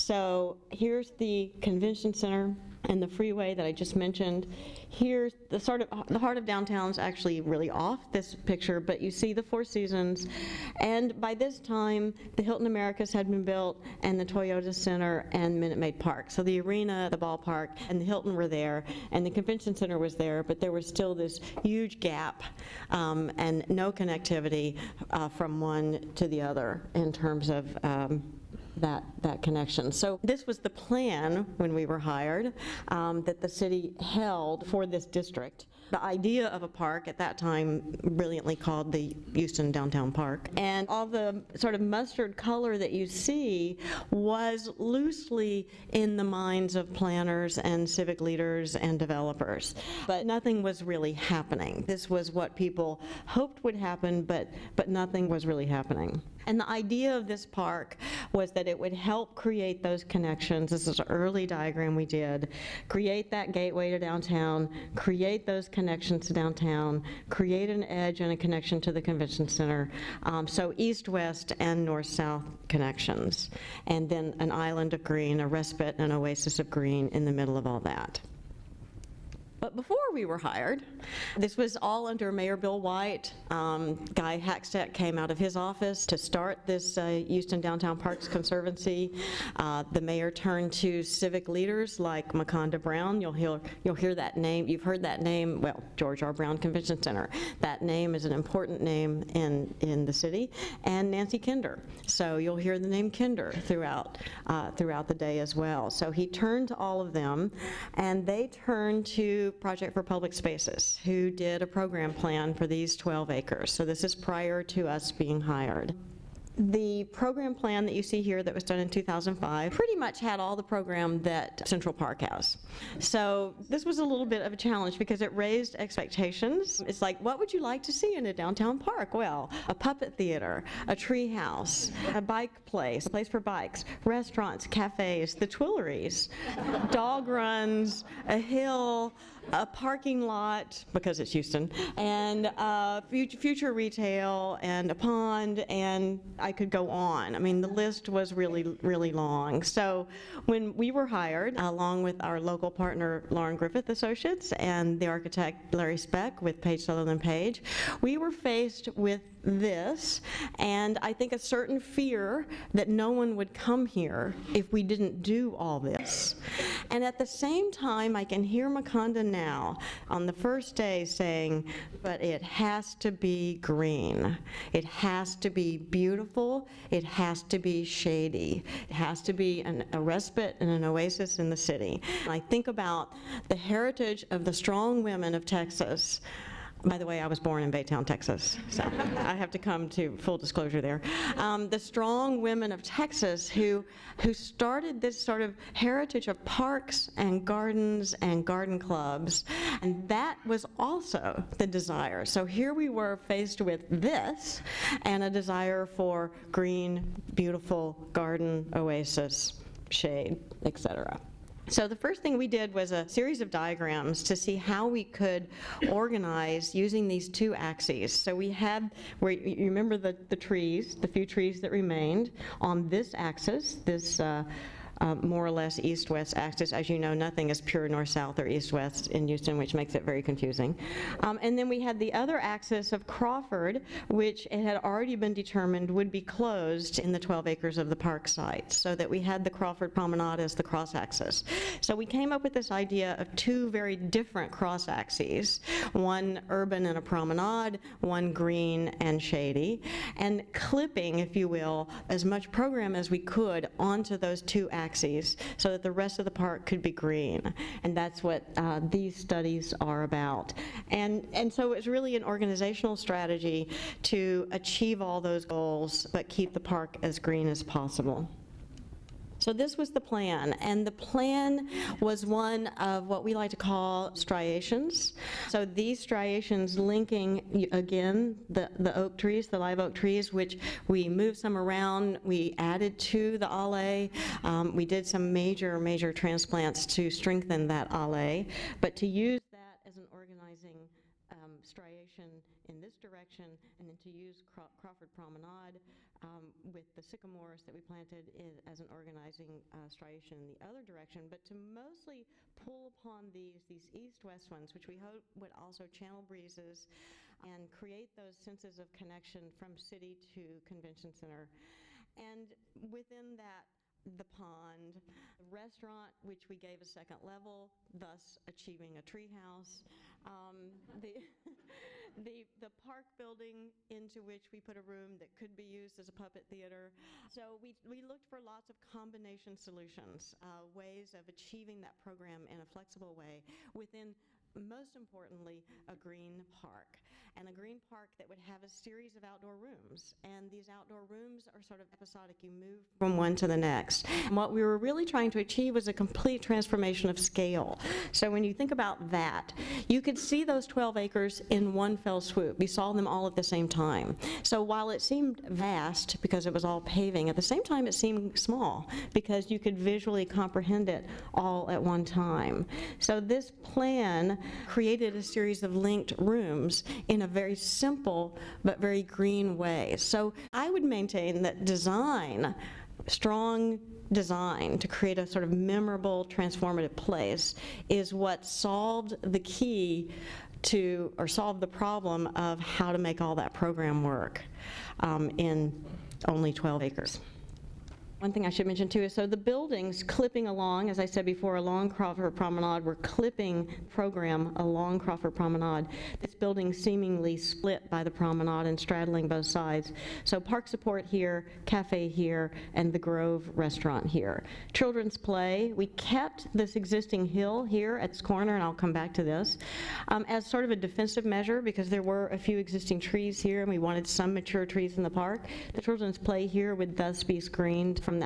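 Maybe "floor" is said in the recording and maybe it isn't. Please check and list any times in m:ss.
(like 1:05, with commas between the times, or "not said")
not said.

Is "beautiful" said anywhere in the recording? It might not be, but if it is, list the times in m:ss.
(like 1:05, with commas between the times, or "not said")
2:55, 3:27.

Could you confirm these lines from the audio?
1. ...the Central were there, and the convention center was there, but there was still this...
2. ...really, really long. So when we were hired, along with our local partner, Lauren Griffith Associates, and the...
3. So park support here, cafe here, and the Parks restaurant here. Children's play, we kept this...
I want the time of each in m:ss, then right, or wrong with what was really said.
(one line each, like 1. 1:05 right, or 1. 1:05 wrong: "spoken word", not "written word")
1. 0:17 wrong: "Hilton", not "Central"
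2. 2:28 right
3. 6:40 wrong: "Grove", not "Parks".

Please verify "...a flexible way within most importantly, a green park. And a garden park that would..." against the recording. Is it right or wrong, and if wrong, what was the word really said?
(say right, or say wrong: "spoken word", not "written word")
wrong: "green", not "garden".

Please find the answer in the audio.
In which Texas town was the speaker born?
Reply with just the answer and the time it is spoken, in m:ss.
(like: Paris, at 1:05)
Baytown, at 3:07.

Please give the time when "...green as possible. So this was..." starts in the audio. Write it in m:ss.
4:27.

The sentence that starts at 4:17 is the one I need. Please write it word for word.
And that's what uh, these studies are about.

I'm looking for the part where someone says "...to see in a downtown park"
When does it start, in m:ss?
2:07.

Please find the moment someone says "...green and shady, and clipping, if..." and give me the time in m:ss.
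4:08.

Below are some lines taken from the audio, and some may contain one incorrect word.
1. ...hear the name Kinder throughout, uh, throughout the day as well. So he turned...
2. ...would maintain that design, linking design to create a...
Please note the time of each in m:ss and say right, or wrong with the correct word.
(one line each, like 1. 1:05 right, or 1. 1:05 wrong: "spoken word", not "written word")
1. 1:42 right
2. 6:10 wrong: "strong", not "linking".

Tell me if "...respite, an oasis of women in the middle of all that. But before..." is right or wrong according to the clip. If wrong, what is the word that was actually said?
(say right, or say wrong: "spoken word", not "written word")
wrong: "green", not "women".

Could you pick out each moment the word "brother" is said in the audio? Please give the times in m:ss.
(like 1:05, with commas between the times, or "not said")
not said.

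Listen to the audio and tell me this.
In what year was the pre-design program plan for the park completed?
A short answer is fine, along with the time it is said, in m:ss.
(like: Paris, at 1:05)
2005, at 1:58.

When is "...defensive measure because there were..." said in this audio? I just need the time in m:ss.
6:50.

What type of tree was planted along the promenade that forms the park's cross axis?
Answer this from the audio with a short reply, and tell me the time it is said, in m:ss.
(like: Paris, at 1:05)
Sycamores, at 4:57.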